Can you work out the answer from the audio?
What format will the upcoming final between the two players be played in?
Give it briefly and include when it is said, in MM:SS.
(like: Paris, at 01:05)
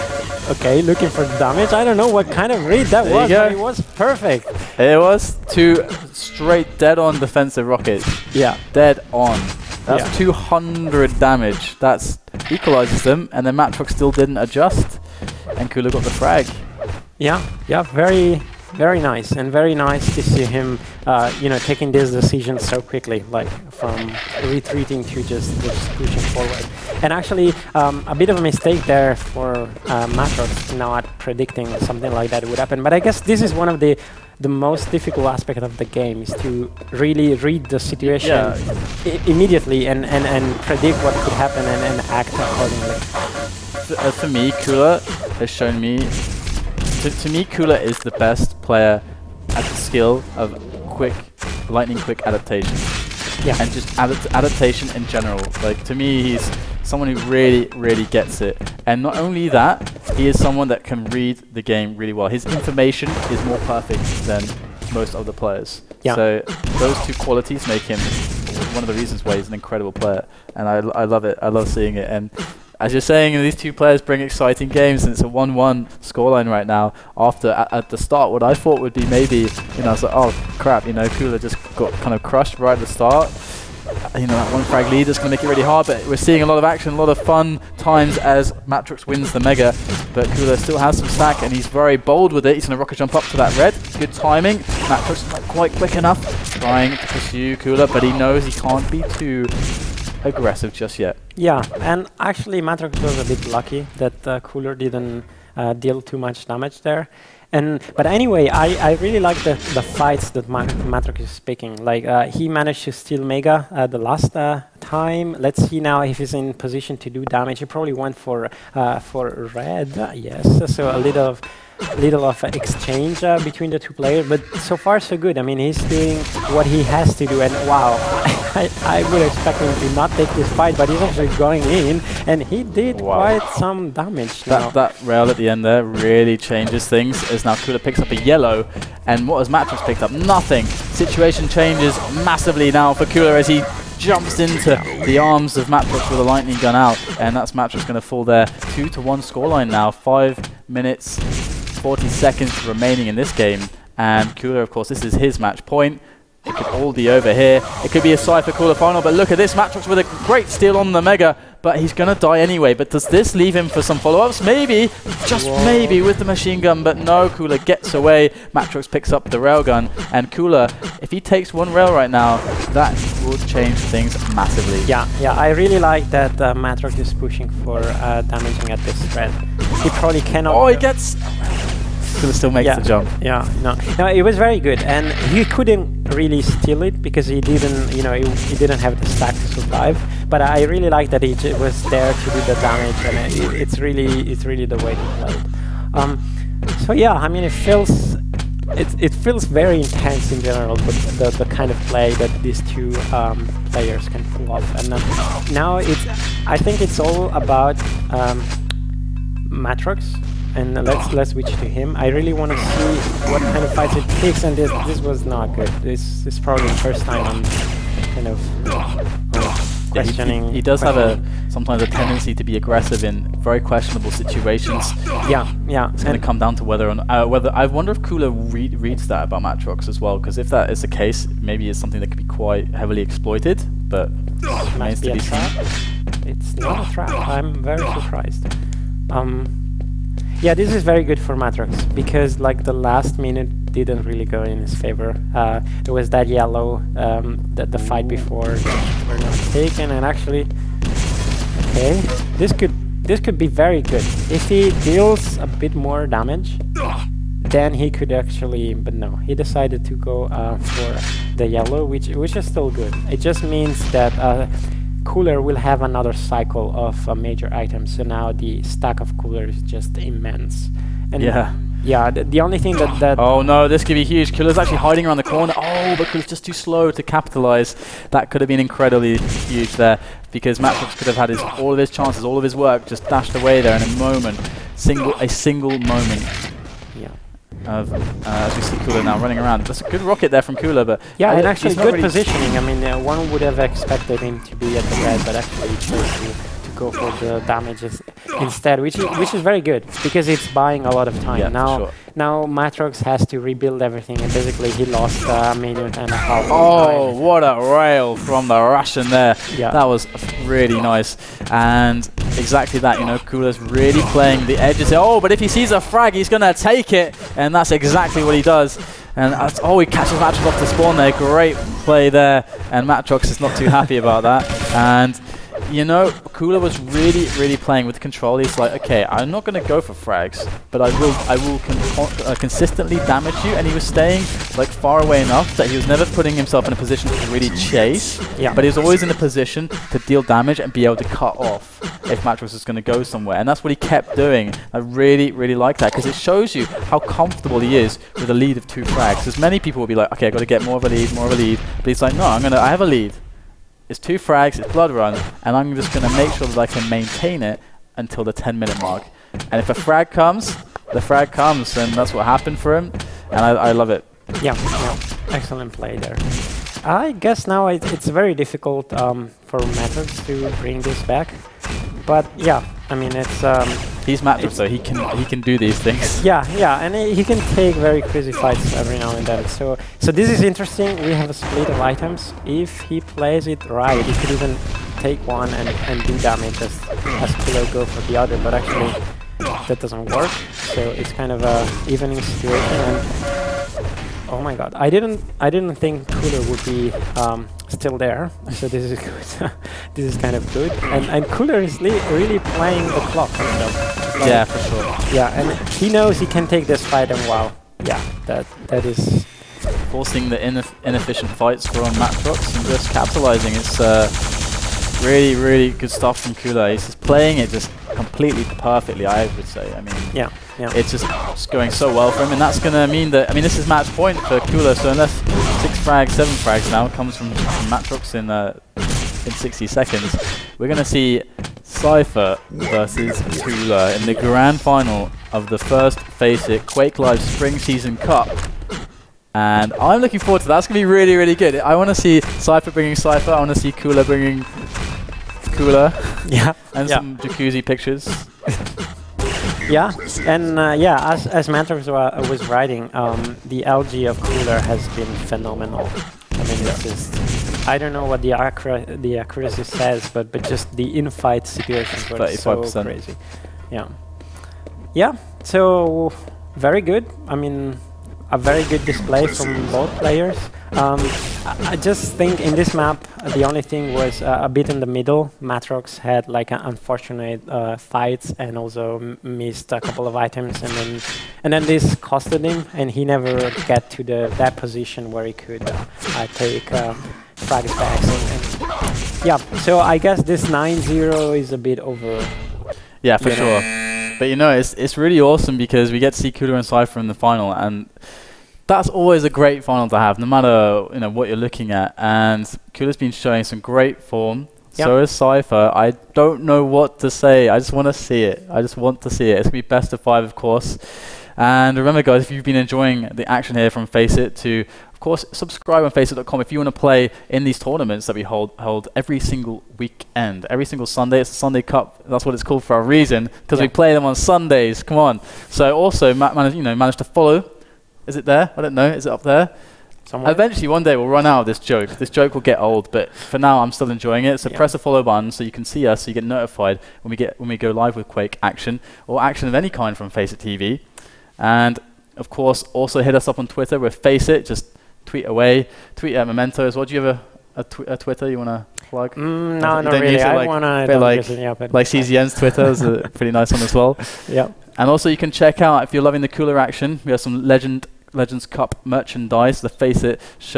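best of 5, at 08:29.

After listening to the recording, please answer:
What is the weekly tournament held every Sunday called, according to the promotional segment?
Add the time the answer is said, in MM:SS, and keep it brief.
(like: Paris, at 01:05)
the Sunday Cup, at 08:41.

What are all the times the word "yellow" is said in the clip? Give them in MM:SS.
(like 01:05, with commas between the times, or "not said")
02:18, 04:06, 04:21.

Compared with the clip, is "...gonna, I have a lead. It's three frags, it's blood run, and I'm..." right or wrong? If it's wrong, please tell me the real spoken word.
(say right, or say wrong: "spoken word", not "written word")
wrong: "two", not "three".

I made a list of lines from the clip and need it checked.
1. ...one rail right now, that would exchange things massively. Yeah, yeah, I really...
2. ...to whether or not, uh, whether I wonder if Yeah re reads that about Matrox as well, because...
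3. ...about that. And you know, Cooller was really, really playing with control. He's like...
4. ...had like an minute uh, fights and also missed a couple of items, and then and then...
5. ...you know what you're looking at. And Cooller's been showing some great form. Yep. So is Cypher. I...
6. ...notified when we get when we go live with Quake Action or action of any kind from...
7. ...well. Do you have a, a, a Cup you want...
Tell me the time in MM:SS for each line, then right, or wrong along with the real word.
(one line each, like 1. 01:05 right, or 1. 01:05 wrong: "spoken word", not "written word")
1. 02:51 wrong: "change", not "exchange"
2. 03:46 wrong: "Cooller", not "Yeah"
3. 05:23 right
4. 07:55 wrong: "unfortunate", not "minute"
5. 08:20 right
6. 08:56 right
7. 09:06 wrong: "Twitter", not "Cup".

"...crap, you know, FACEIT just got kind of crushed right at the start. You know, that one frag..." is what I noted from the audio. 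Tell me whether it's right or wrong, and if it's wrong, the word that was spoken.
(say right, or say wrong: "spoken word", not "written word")
wrong: "Cooller", not "FACEIT".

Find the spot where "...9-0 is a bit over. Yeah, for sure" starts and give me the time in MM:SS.
08:10.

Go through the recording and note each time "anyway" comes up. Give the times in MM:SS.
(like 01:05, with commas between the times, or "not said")
01:48, 02:42.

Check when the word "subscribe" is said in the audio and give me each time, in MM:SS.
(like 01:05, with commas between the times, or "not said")
08:35.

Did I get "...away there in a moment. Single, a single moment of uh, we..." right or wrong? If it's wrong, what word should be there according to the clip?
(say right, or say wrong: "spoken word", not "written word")
right.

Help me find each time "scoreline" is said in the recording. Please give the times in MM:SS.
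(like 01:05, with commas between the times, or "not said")
01:15, 02:29.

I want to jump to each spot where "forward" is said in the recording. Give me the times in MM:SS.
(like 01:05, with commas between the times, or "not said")
00:26, 07:20.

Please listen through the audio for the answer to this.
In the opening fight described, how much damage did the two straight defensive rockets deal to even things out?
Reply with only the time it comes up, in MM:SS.
00:10.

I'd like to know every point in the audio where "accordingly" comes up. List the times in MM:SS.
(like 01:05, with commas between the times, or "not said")
00:42.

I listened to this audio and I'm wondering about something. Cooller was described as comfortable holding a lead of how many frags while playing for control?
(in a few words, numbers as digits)
2.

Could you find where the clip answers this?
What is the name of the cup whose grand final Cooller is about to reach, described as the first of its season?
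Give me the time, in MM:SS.
07:15.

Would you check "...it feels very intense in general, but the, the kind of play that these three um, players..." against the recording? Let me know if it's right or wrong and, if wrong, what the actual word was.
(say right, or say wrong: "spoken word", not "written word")
wrong: "two", not "three".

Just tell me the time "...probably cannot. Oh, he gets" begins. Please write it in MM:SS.
02:59.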